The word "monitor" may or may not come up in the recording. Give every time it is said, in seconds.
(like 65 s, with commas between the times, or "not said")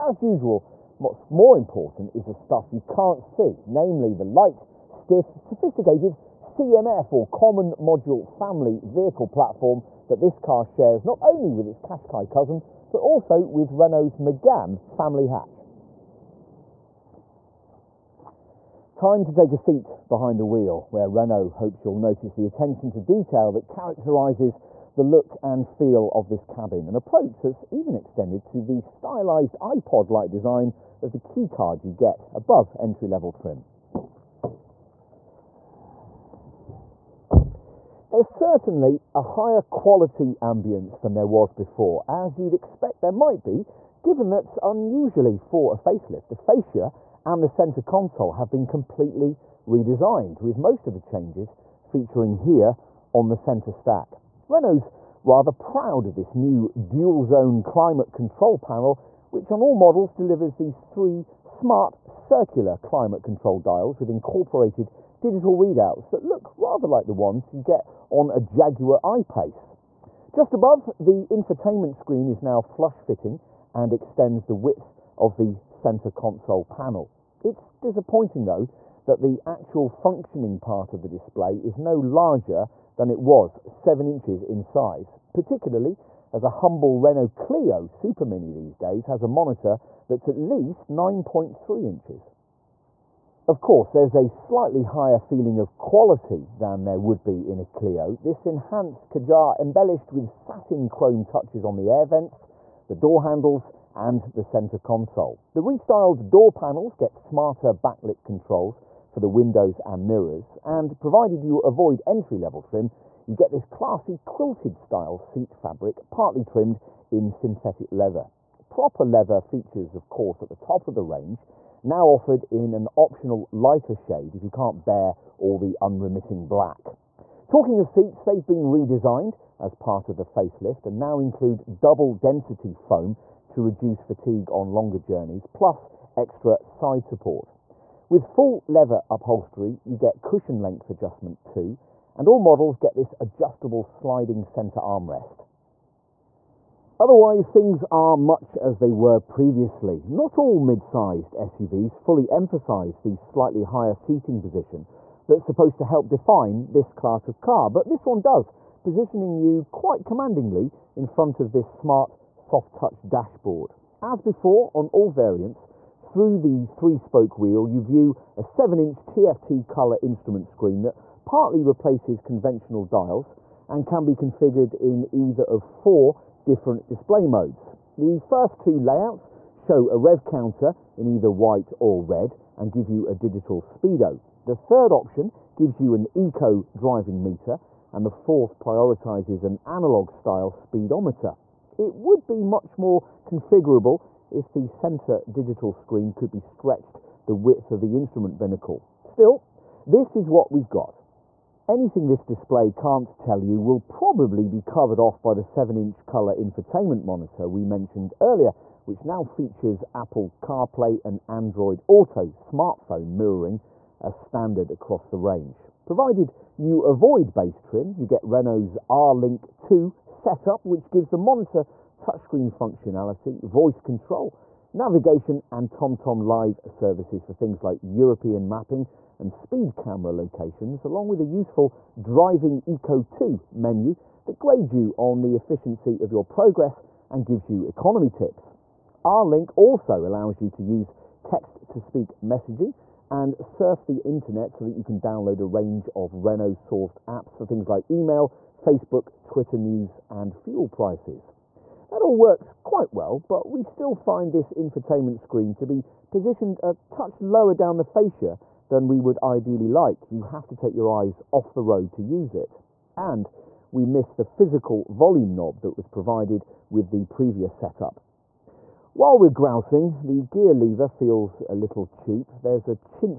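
89 s, 207 s, 221 s.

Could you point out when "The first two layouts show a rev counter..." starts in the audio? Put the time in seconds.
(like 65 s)
177 s.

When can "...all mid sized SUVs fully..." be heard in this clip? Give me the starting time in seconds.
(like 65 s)
150 s.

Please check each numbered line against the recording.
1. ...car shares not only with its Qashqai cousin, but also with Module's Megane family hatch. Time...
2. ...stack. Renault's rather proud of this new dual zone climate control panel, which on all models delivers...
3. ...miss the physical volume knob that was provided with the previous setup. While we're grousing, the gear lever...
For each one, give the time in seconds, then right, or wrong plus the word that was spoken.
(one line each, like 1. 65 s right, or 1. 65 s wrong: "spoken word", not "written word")
1. 10 s wrong: "Renault", not "Module"
2. 53 s right
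3. 263 s right.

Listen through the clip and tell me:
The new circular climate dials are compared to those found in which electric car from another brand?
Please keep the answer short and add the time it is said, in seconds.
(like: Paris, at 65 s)
Jaguar I-Pace, at 68 s.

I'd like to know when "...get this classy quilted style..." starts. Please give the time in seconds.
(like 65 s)
113 s.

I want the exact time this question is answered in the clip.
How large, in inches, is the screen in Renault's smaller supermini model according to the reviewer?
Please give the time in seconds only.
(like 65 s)
90 s.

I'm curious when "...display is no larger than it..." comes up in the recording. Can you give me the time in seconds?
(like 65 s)
81 s.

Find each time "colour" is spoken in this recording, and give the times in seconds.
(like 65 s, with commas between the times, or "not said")
169 s, 206 s.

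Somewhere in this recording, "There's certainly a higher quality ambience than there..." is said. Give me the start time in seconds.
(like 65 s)
38 s.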